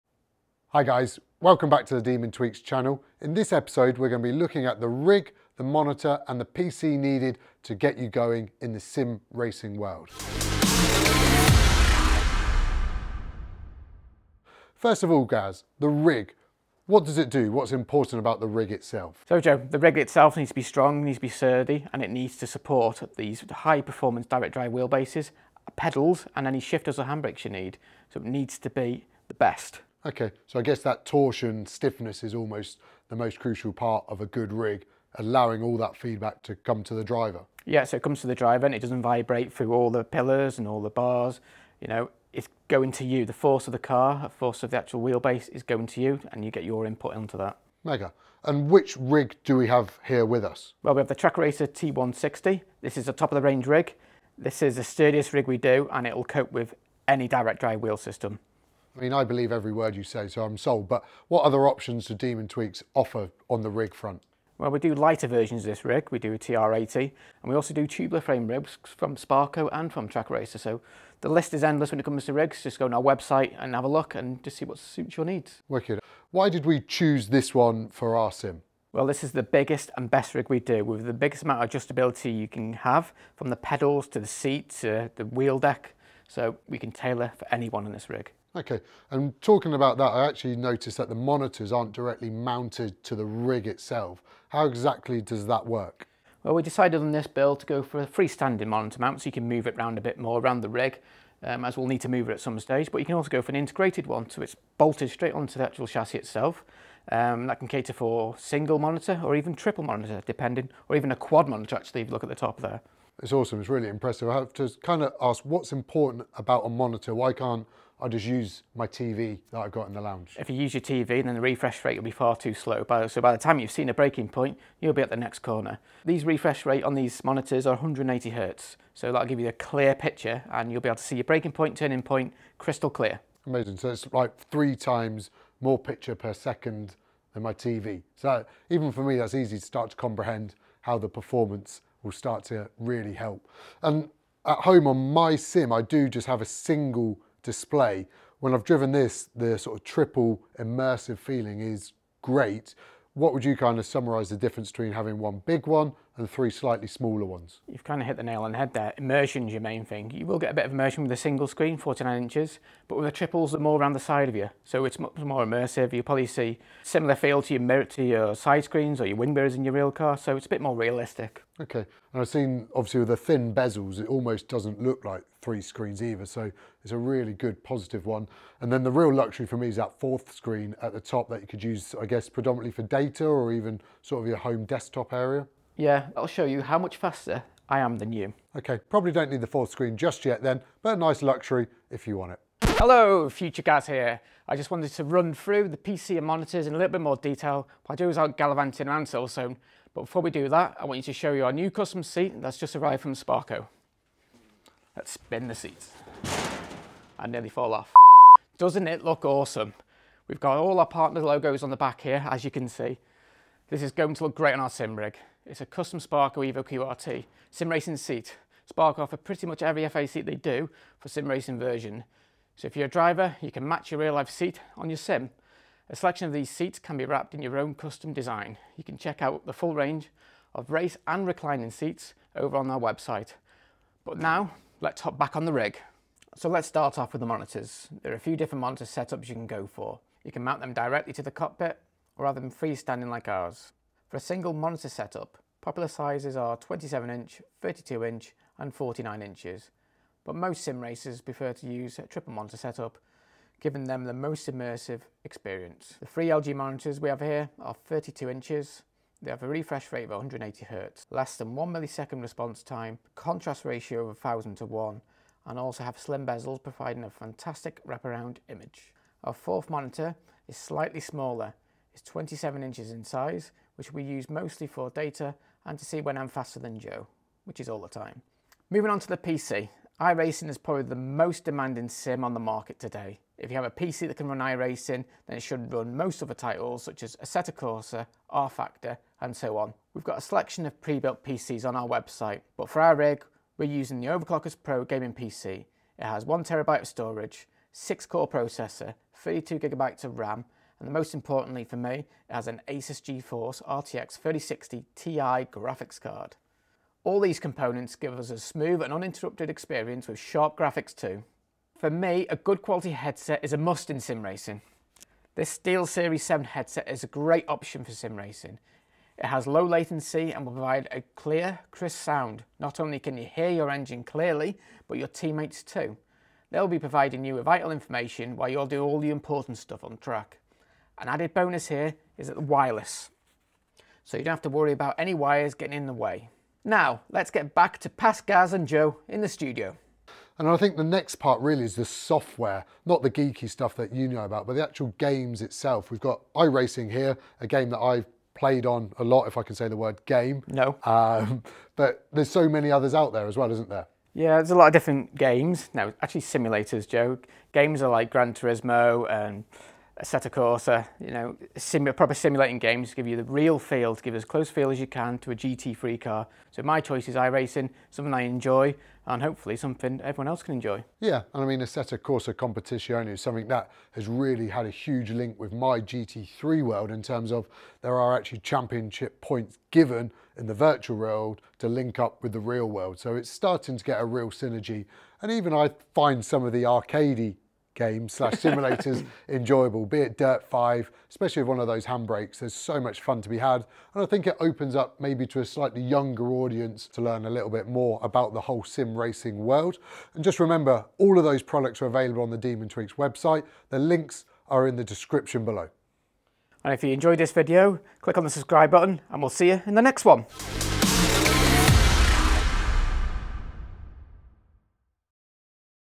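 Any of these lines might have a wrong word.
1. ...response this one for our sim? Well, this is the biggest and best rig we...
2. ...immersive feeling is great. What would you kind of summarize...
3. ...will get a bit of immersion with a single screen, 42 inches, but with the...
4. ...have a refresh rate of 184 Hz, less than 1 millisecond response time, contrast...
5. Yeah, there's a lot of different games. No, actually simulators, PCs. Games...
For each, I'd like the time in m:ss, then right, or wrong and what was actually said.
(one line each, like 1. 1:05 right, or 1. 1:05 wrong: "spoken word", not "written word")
1. 1:16 wrong: "choose", not "response"
2. 2:30 right
3. 2:40 wrong: "49", not "42"
4. 4:19 wrong: "180", not "184"
5. 5:54 wrong: "Joe", not "PCs".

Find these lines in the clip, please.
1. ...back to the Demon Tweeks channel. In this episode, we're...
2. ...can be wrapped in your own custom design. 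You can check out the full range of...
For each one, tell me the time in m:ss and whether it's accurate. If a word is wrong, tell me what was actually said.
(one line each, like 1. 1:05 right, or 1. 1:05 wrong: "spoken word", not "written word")
1. 0:01 right
2. 3:46 right.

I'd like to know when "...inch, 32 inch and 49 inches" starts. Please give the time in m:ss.
4:07.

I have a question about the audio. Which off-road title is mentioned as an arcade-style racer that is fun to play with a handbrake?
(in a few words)
Dirt 5.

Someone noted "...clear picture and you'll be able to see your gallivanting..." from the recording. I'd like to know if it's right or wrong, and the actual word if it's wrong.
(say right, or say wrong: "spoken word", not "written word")
wrong: "braking", not "gallivanting".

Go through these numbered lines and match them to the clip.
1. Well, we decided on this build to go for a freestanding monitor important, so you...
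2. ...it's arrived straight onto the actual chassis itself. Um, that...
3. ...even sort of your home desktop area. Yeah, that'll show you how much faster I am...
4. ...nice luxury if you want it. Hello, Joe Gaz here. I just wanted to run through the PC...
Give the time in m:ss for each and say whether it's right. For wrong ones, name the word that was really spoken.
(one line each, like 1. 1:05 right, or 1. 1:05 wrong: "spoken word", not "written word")
1. 1:36 wrong: "mount", not "important"
2. 1:44 wrong: "bolted", not "arrived"
3. 3:03 right
4. 3:10 wrong: "Future", not "Joe".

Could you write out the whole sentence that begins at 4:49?
We've got a selection of pre-built PCs on our website, but for our rig, we're using the Overclockers Pro gaming PC.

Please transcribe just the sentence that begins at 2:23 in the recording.
And at home on my sim, I do just have a single display.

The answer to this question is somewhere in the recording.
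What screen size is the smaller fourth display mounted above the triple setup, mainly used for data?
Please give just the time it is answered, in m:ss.
4:32.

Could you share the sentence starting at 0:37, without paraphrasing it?
Yeah, so it comes to the driver and it doesn't vibrate through all the pillars and all the bars.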